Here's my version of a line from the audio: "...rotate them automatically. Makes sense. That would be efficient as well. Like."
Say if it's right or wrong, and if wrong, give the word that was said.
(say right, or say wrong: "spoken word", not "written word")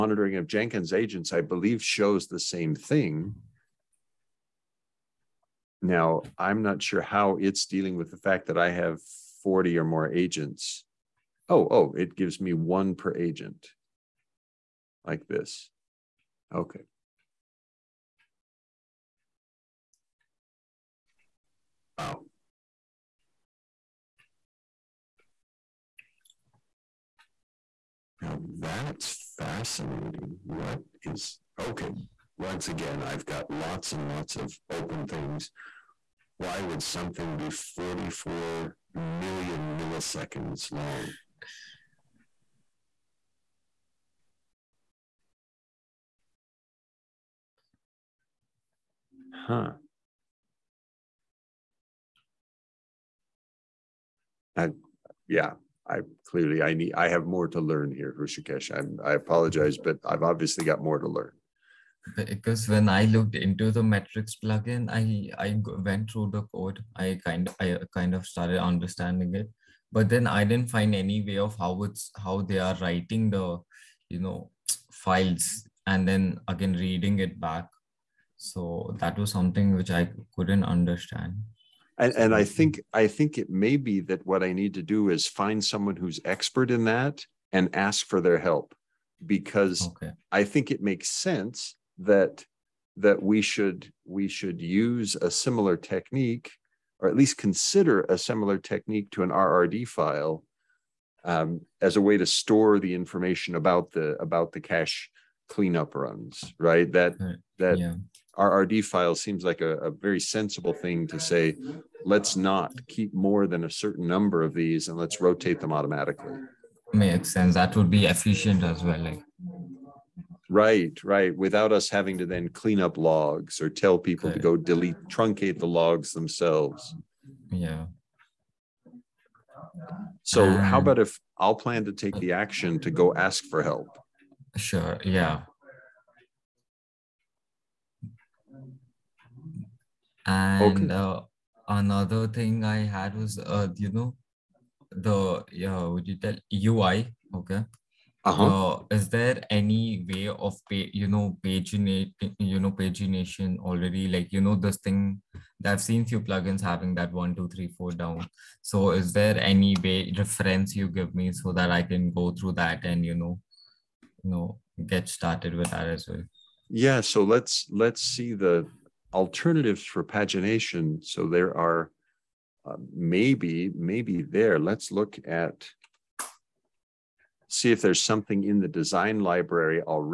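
right.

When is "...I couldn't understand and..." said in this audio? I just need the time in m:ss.
1:19.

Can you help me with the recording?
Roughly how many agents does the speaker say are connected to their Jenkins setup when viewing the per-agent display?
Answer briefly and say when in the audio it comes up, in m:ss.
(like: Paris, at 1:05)
40, at 0:09.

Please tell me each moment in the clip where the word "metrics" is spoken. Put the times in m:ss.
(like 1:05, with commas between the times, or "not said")
1:03.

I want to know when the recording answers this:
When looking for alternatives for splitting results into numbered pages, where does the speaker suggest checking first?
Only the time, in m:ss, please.
2:58.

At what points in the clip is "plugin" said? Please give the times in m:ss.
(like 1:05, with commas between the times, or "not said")
1:04, 2:36.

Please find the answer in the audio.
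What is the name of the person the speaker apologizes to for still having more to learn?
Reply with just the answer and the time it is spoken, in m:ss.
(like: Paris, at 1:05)
Hrushikesh, at 0:58.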